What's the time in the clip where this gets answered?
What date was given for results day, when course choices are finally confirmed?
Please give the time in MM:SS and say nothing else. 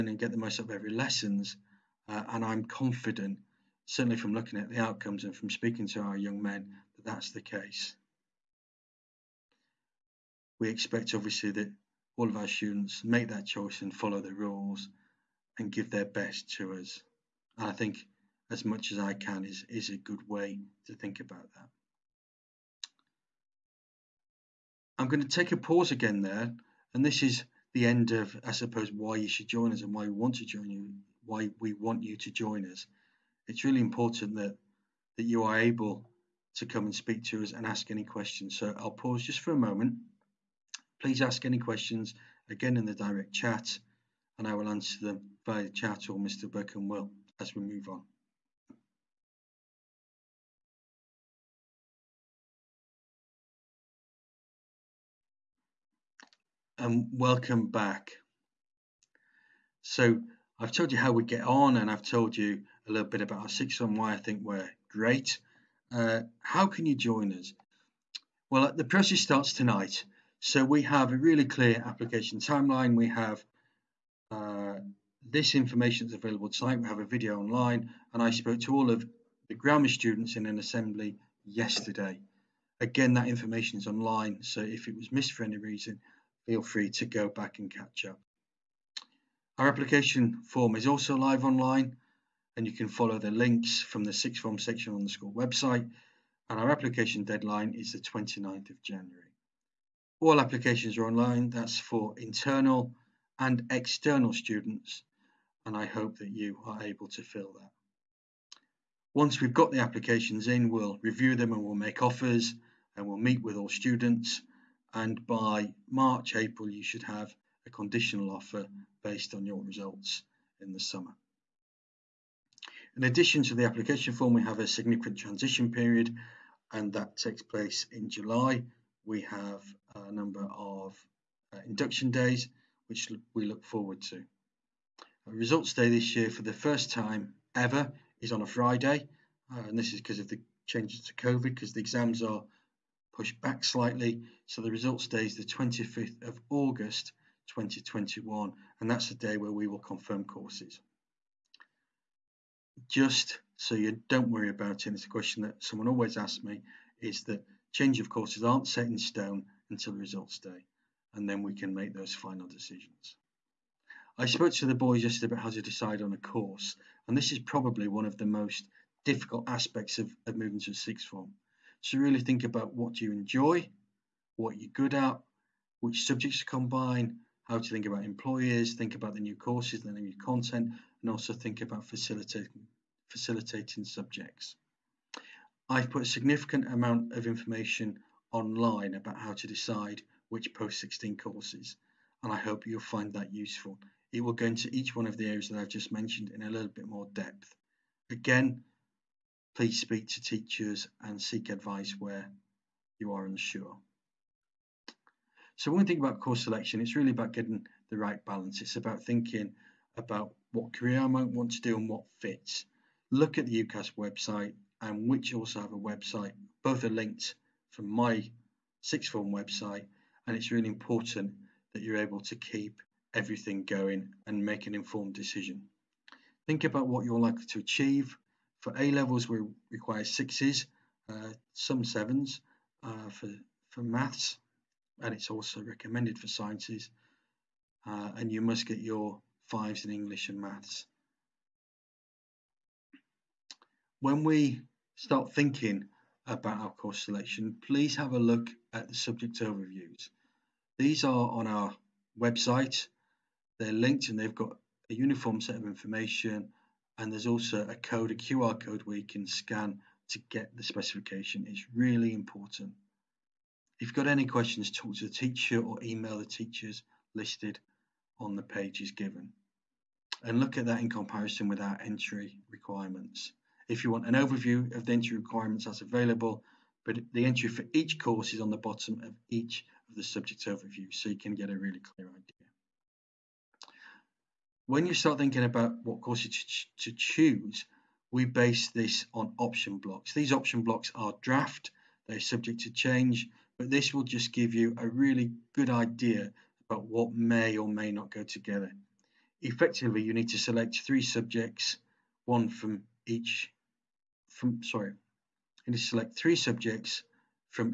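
02:25.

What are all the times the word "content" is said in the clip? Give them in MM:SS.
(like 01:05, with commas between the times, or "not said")
03:00.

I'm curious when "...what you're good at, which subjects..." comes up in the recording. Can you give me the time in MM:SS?
02:54.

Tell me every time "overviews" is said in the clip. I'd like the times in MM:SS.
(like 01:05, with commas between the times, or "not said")
04:09, 04:34, 04:40.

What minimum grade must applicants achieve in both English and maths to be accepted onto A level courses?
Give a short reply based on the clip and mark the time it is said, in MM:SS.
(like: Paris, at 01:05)
5, at 03:59.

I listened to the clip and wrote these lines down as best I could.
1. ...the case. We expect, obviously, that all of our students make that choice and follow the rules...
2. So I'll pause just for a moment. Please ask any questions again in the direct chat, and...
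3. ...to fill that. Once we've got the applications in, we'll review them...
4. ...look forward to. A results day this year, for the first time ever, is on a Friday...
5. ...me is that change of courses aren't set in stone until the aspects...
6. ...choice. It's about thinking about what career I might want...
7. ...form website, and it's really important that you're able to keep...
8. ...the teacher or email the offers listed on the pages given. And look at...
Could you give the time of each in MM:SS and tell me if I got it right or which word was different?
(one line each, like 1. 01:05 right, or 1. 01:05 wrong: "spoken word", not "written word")
1. 00:07 right
2. 00:38 right
3. 01:47 right
4. 02:13 right
5. 02:36 wrong: "results", not "aspects"
6. 03:28 wrong: "balance", not "choice"
7. 03:39 right
8. 04:25 wrong: "teachers", not "offers".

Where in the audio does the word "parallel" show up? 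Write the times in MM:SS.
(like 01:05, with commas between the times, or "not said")
not said.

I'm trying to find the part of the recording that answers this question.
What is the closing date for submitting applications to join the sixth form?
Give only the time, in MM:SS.
01:37.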